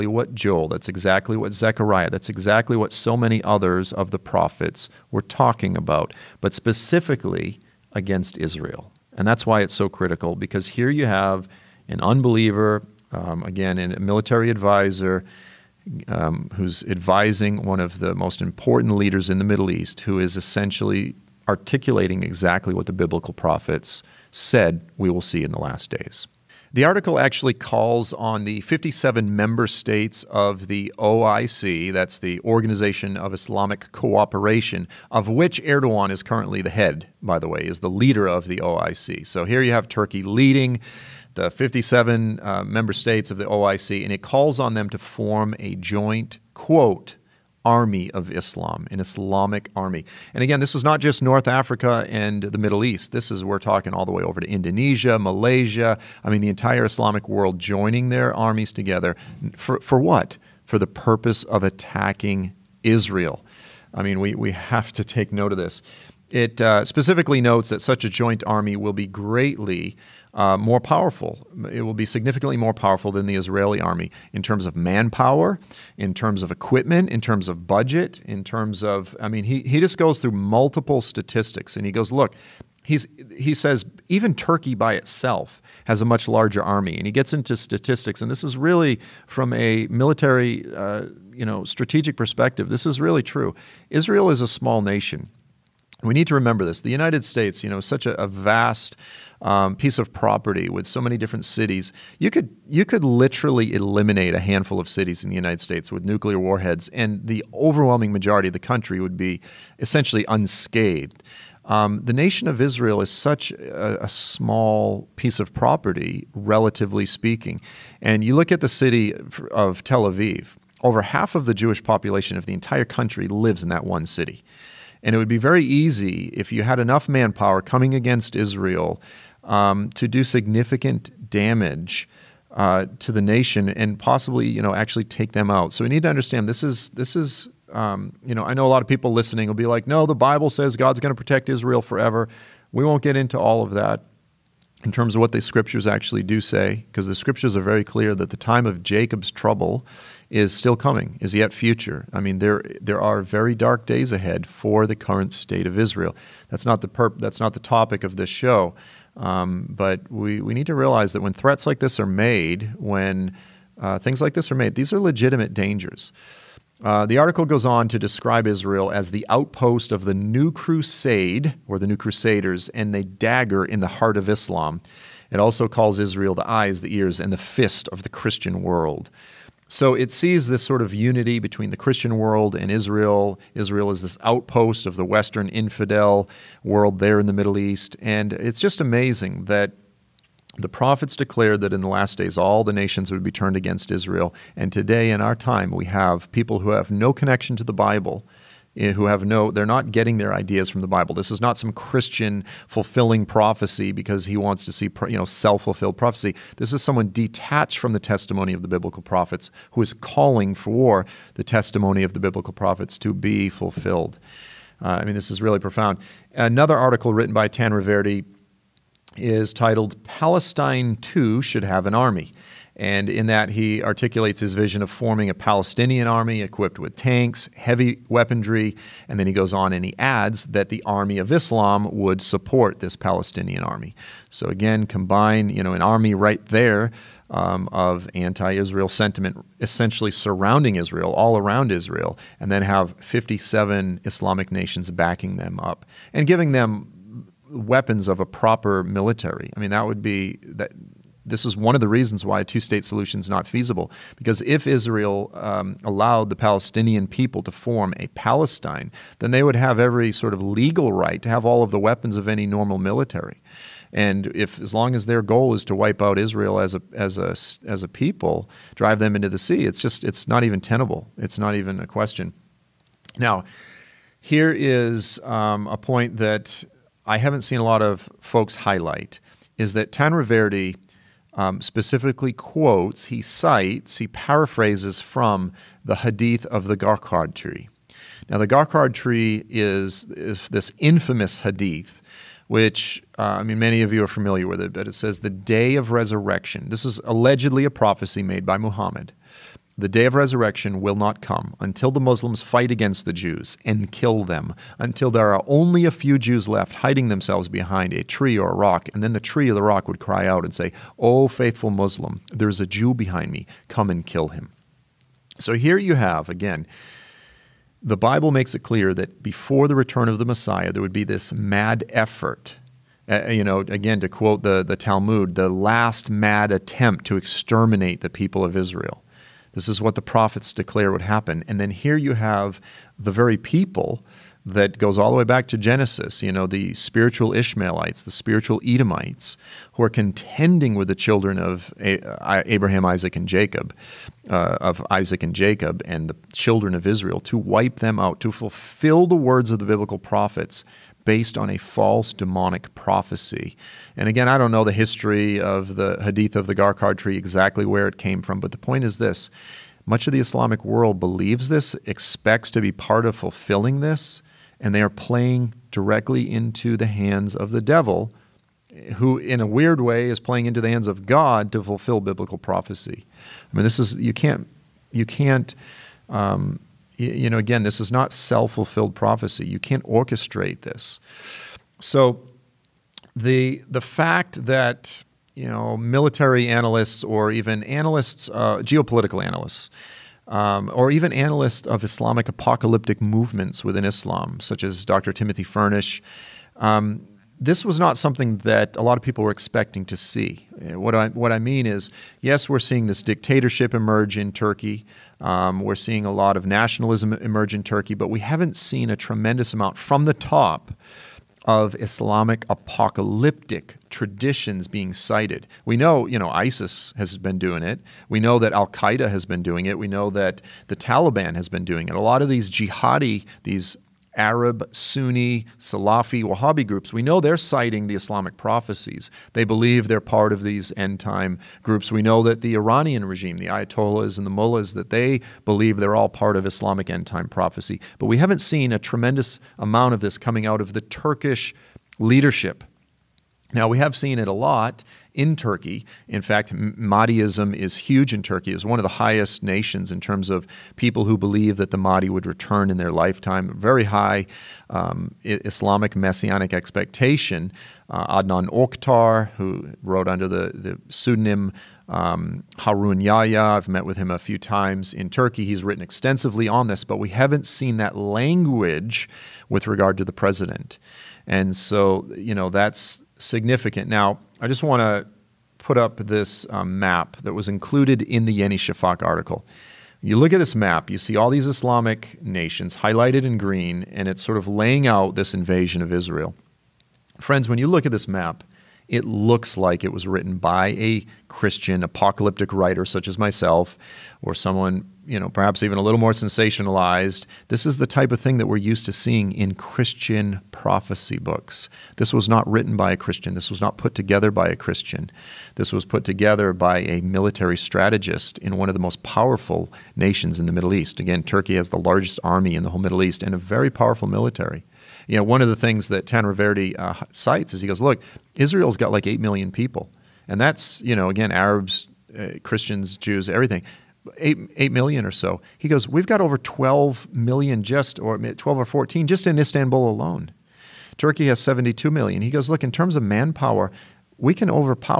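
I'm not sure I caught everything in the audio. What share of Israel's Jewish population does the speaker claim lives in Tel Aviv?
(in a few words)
over half.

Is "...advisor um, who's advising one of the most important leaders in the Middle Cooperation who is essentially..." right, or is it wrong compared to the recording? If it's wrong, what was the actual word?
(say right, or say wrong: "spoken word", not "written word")
wrong: "East", not "Cooperation".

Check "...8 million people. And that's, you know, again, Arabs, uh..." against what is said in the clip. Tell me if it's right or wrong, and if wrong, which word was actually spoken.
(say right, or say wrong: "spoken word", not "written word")
right.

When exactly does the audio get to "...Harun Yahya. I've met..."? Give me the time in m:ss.
7:42.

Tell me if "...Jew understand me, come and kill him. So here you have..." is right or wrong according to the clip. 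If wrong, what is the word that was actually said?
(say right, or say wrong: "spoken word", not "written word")
wrong: "behind", not "understand".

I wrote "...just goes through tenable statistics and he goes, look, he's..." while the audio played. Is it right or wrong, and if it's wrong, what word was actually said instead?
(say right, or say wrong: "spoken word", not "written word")
wrong: "multiple", not "tenable".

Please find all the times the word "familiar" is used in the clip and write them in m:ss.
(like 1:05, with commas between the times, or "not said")
4:54.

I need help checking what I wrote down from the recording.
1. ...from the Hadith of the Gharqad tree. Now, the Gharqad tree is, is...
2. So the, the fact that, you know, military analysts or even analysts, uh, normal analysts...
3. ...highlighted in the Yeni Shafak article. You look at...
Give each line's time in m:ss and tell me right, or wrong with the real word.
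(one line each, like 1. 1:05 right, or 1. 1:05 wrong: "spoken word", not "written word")
1. 4:45 right
2. 6:21 wrong: "geopolitical", not "normal"
3. 7:57 wrong: "included", not "highlighted".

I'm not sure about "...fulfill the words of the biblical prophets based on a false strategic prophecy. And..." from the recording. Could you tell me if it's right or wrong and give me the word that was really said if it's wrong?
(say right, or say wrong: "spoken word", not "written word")
wrong: "demonic", not "strategic".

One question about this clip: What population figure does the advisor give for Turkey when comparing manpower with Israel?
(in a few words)
72 million.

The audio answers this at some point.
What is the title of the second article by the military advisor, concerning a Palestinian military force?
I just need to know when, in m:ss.
3:40.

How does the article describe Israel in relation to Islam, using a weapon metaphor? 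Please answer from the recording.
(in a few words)
the dagger in the heart of Islam.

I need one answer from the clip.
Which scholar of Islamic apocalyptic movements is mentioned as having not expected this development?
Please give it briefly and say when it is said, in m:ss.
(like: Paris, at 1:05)
Dr. Timothy Furnish, at 6:34.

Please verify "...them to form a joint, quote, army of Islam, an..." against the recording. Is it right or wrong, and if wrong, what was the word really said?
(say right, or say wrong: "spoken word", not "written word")
right.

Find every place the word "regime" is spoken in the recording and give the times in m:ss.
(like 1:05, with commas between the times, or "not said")
7:13.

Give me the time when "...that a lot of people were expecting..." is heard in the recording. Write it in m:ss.
6:38.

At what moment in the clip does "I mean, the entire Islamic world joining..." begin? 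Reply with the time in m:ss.
0:56.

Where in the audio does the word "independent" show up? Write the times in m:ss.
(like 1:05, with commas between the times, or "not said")
not said.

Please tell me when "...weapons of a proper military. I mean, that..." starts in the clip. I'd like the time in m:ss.
4:07.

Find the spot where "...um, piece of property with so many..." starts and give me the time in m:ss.
1:39.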